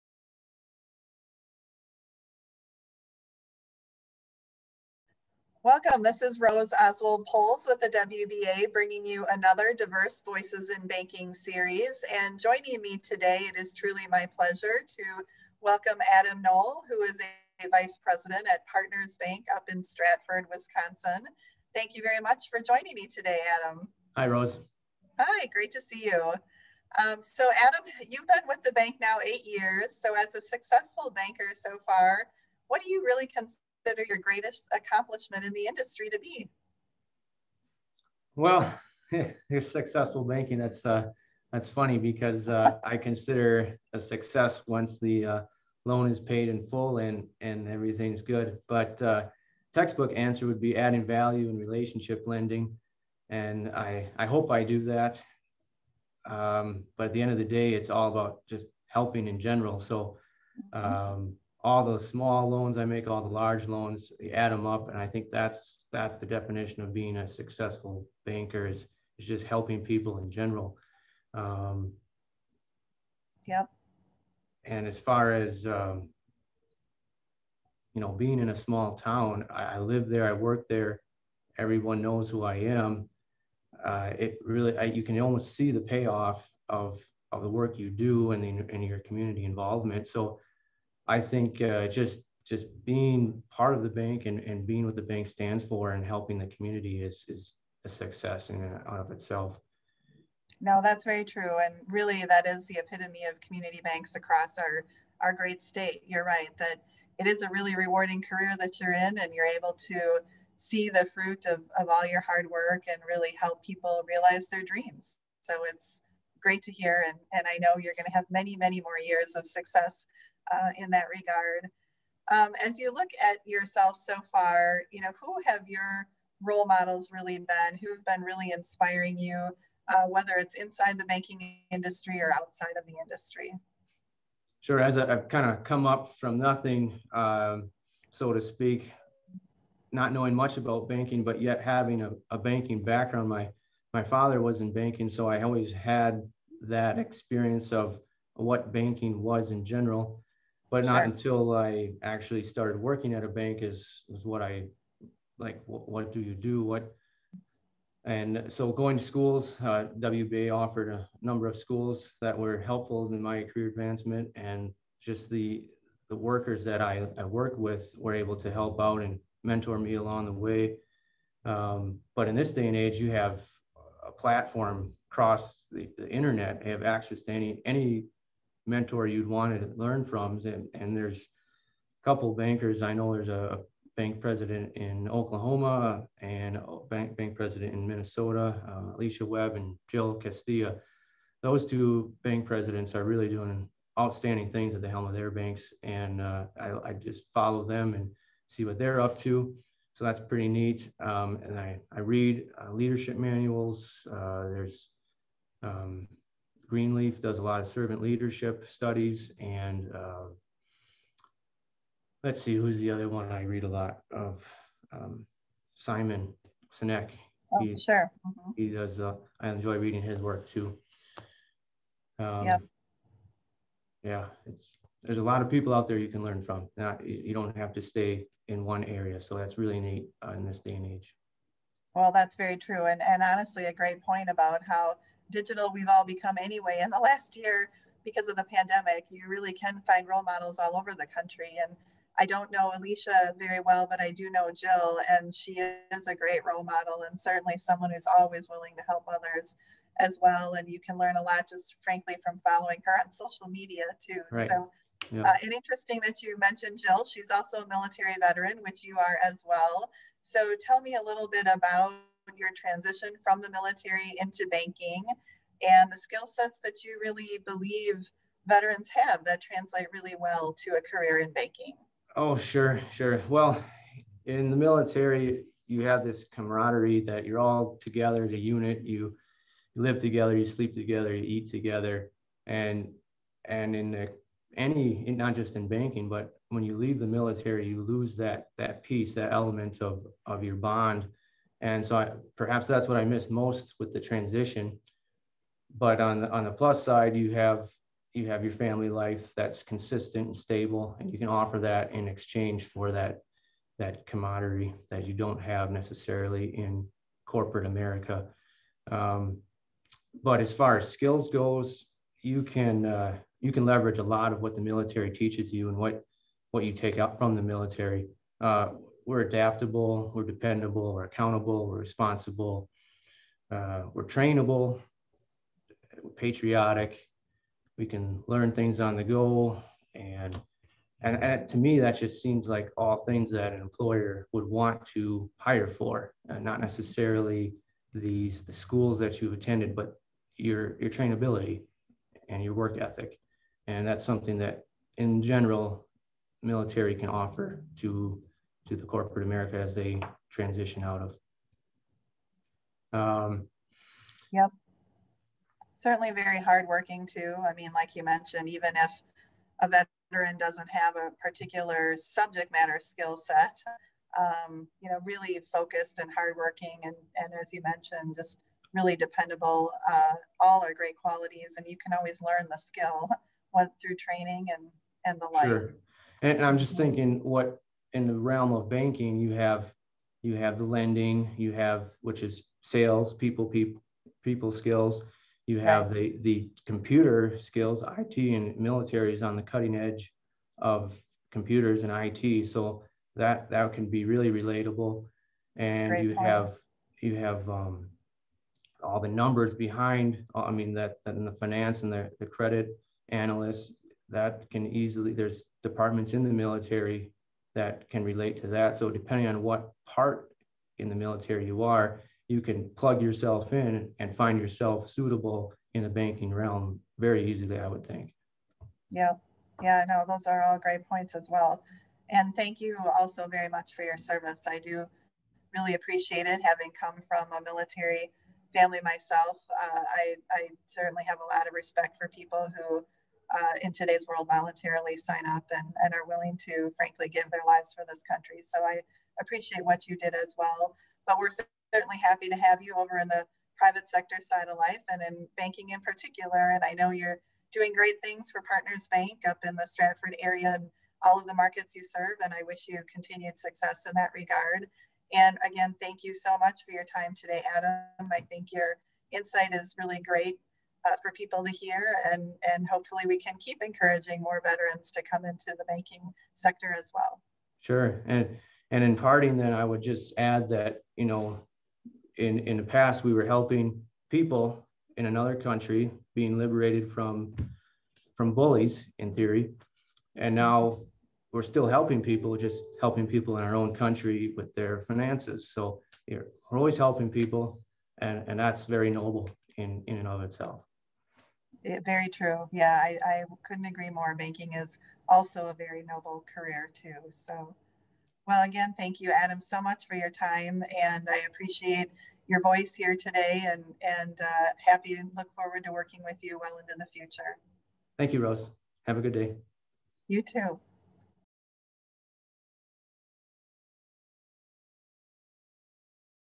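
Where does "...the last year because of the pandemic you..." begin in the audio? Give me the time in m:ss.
3:56.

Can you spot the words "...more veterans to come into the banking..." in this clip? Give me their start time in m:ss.
7:44.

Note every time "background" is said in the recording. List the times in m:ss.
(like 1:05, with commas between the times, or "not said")
2:22.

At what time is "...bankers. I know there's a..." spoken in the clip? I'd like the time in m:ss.
3:02.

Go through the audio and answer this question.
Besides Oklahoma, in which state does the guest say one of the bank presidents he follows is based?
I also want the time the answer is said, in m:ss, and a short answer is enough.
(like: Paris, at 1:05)
Minnesota, at 3:07.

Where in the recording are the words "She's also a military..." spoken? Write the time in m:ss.
4:17.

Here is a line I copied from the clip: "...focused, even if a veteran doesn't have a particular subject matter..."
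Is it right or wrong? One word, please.
wrong.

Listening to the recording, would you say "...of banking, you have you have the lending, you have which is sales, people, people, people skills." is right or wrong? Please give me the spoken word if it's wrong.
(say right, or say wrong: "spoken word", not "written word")
right.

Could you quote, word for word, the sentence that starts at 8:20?
And I appreciate your voice here today and, and uh, happy and look forward to working with you well into the future.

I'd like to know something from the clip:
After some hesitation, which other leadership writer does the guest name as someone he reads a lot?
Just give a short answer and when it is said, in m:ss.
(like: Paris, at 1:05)
Simon Sinek, at 3:35.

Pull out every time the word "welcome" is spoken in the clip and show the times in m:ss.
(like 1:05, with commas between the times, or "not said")
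0:05, 0:15.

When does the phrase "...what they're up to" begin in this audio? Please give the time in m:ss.
3:18.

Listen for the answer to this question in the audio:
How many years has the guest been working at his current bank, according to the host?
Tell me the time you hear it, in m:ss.
0:29.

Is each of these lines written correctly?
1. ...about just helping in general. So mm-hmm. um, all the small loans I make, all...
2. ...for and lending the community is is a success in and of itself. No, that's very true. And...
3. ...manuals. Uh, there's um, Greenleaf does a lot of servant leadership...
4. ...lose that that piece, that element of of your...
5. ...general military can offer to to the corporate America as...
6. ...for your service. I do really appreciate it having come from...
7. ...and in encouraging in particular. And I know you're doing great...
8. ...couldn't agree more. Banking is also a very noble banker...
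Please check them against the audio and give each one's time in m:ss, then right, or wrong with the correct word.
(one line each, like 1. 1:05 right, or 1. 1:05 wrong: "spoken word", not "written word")
1. 0:58 right
2. 1:35 wrong: "helping", not "lending"
3. 3:23 right
4. 4:47 right
5. 5:45 right
6. 7:03 right
7. 7:24 wrong: "banking", not "encouraging"
8. 8:13 wrong: "career", not "banker".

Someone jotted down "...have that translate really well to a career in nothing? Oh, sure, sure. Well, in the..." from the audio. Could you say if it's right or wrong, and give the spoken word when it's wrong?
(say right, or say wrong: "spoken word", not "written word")
wrong: "banking", not "nothing".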